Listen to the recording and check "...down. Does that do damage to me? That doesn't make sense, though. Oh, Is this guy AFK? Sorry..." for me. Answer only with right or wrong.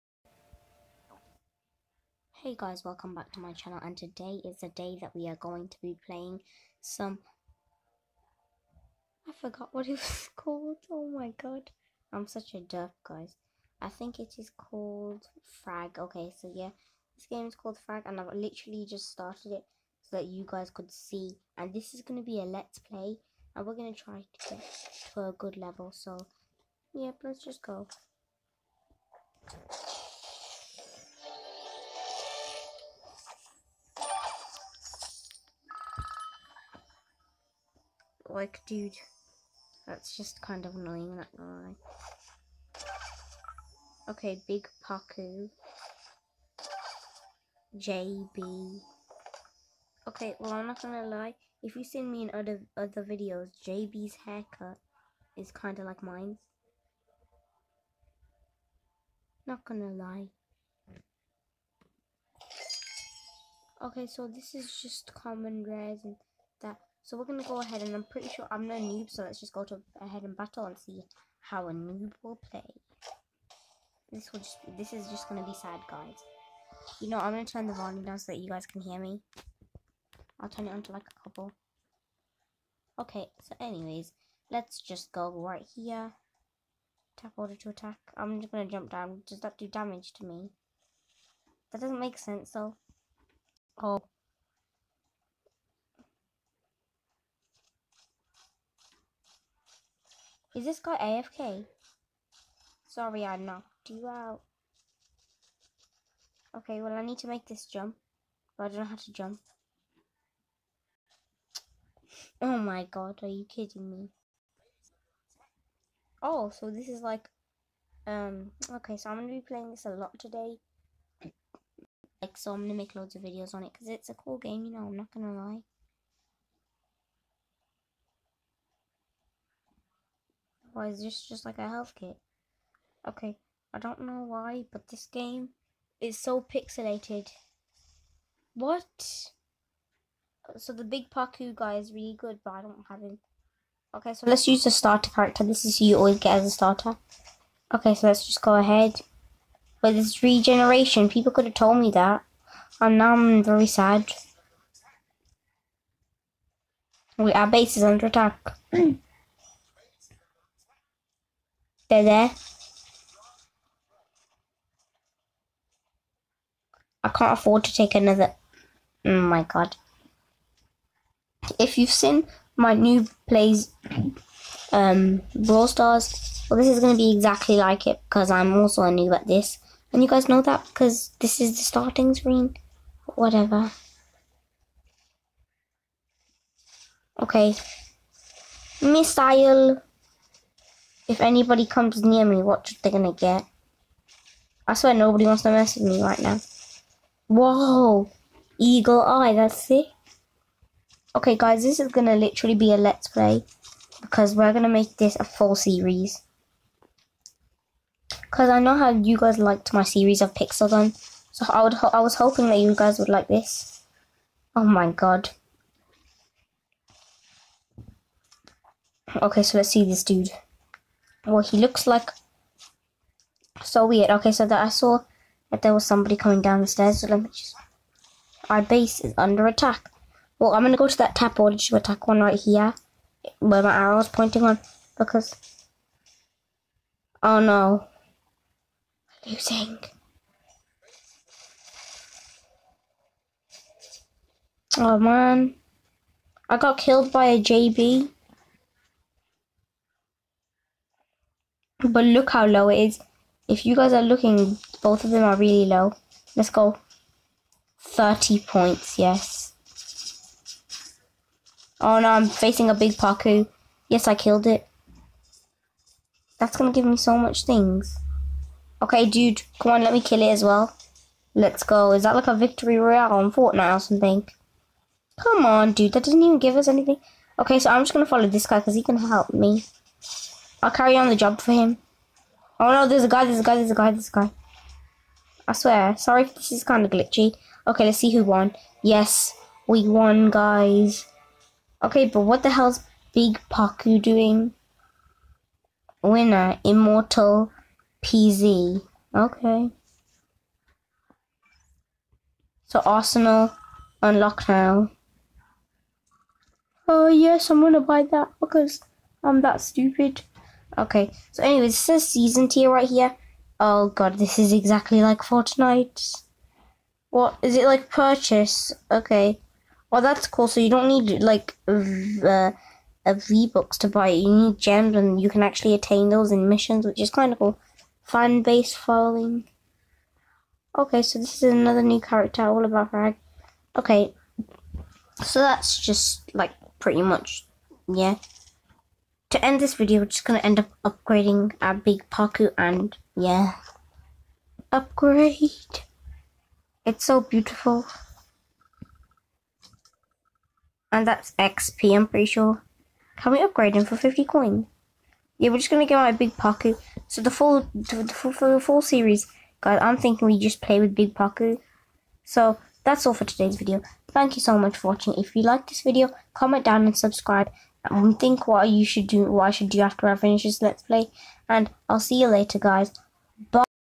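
right.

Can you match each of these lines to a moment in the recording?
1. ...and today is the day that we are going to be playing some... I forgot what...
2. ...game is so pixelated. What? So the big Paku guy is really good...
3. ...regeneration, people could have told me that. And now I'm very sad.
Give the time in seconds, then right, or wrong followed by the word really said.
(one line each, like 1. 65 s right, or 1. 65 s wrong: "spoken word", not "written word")
1. 3 s right
2. 135 s right
3. 150 s right.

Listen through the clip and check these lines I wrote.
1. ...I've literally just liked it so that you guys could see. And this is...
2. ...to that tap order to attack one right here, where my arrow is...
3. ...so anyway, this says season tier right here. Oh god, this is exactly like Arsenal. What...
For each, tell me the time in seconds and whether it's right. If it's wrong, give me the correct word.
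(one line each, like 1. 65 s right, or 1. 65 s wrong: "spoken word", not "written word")
1. 18 s wrong: "started", not "liked"
2. 230 s right
3. 311 s wrong: "Fortnite", not "Arsenal".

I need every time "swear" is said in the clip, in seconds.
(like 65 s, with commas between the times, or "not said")
194 s, 285 s.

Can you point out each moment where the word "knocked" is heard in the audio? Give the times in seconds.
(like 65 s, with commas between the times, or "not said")
103 s.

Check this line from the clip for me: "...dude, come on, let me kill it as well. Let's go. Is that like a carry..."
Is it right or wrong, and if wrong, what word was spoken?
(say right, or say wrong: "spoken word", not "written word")
wrong: "victory", not "carry".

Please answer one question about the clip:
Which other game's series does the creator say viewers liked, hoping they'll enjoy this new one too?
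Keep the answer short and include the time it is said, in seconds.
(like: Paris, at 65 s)
Pixel Gun, at 210 s.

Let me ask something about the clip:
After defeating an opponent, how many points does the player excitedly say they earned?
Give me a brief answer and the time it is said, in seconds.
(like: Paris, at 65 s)
30, at 257 s.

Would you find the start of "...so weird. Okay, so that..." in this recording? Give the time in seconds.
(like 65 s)
223 s.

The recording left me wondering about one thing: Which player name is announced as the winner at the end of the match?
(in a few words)
Immortal PZ.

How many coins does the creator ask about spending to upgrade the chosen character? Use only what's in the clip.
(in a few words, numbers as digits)
50.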